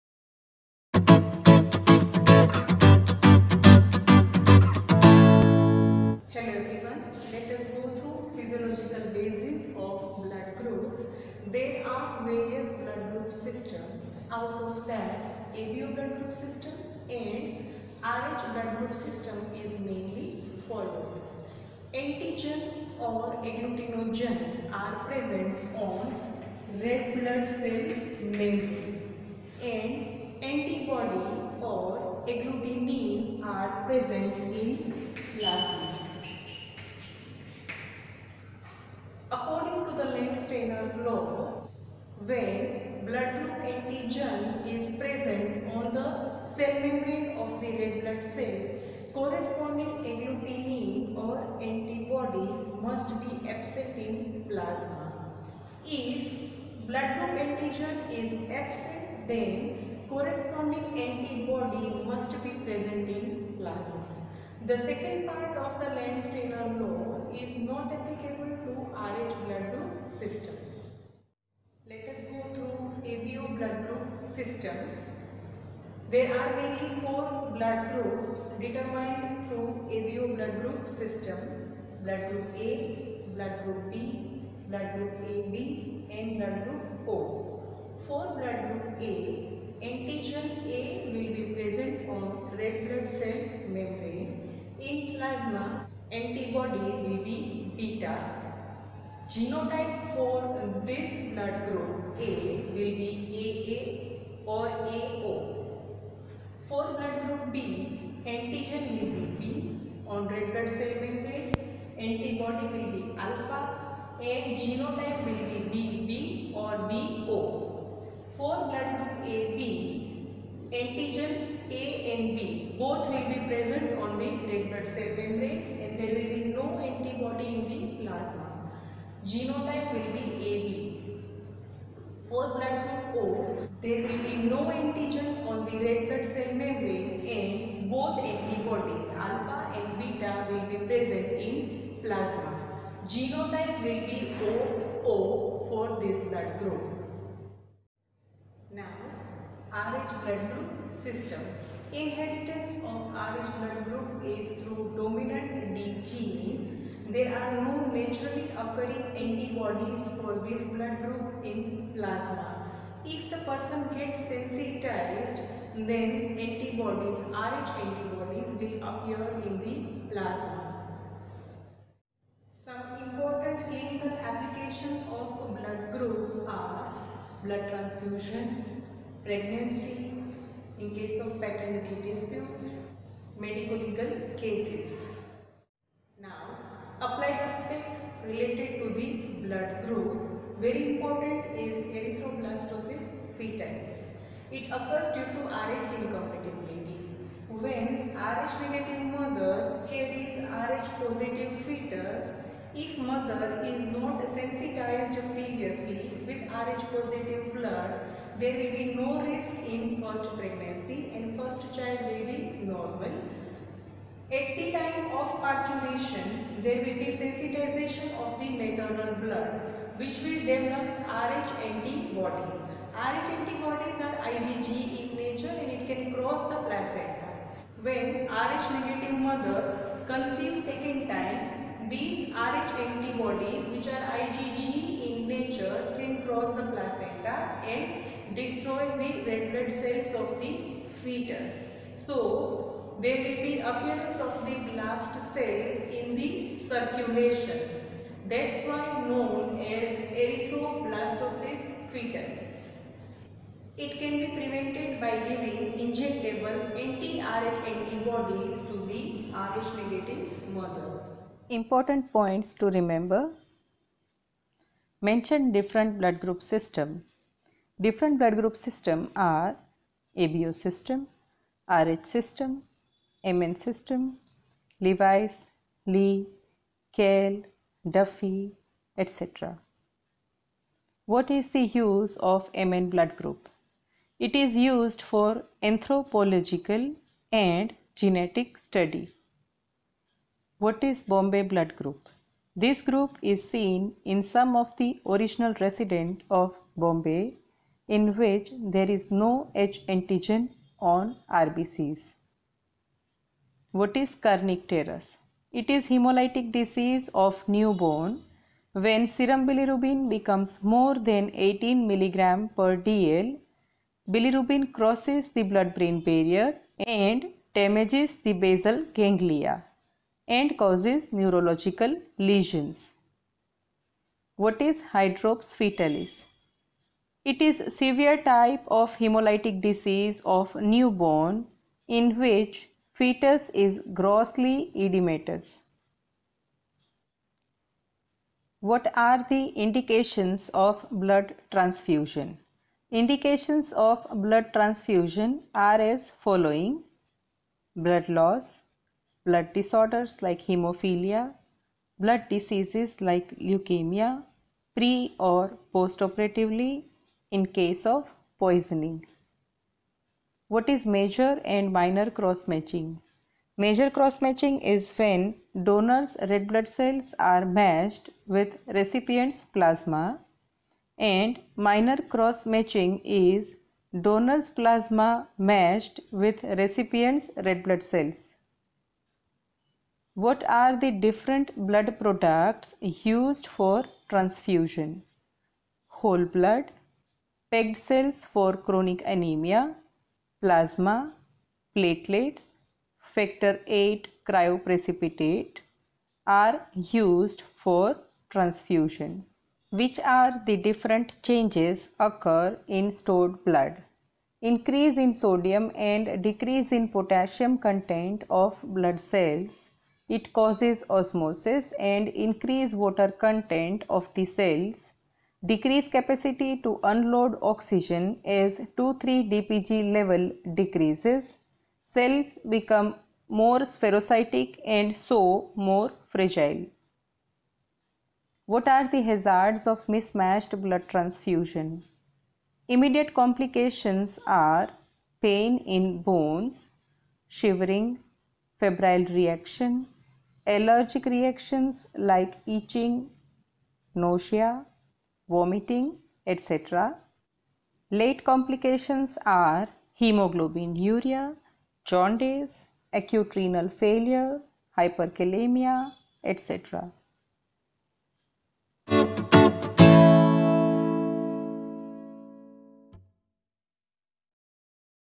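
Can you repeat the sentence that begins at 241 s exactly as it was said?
So, there will be appearance of the blast cells in the circulation.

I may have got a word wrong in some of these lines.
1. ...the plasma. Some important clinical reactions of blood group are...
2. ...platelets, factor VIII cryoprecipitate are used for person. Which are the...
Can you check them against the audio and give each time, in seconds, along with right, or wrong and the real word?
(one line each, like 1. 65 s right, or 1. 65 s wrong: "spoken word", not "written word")
1. 169 s wrong: "applications", not "reactions"
2. 391 s wrong: "transfusion", not "person".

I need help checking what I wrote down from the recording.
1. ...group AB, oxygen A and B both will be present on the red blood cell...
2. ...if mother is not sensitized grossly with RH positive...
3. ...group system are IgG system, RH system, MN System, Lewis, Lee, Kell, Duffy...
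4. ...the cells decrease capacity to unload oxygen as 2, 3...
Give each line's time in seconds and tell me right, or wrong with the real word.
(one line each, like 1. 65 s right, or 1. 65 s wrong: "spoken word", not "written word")
1. 118 s wrong: "antigen", not "oxygen"
2. 202 s wrong: "previously", not "grossly"
3. 268 s wrong: "ABO", not "IgG"
4. 414 s right.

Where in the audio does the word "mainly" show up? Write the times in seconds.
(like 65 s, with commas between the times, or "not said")
19 s, 76 s.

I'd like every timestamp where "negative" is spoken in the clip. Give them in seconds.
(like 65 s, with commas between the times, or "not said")
198 s, 228 s, 259 s.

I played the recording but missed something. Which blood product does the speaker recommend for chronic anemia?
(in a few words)
Packed cells.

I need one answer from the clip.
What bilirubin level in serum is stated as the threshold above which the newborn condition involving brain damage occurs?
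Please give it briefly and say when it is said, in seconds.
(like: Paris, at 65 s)
18 mg per dl, at 311 s.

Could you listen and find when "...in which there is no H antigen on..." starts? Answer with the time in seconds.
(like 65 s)
297 s.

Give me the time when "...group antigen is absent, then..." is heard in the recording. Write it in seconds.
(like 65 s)
57 s.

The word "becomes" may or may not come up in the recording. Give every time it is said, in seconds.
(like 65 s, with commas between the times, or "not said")
310 s, 422 s.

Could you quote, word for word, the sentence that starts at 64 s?
The second part of the Landsteiner law is not applicable to RH blood group system.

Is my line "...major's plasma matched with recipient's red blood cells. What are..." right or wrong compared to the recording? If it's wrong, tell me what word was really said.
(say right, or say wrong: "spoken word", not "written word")
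wrong: "donor", not "major".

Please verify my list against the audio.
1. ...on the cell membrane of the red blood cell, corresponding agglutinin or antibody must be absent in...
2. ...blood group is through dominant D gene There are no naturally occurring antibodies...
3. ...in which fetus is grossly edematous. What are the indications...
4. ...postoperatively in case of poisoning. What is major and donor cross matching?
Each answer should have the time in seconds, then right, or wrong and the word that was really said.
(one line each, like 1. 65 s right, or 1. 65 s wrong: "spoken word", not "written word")
1. 45 s right
2. 153 s right
3. 331 s right
4. 355 s wrong: "minor", not "donor".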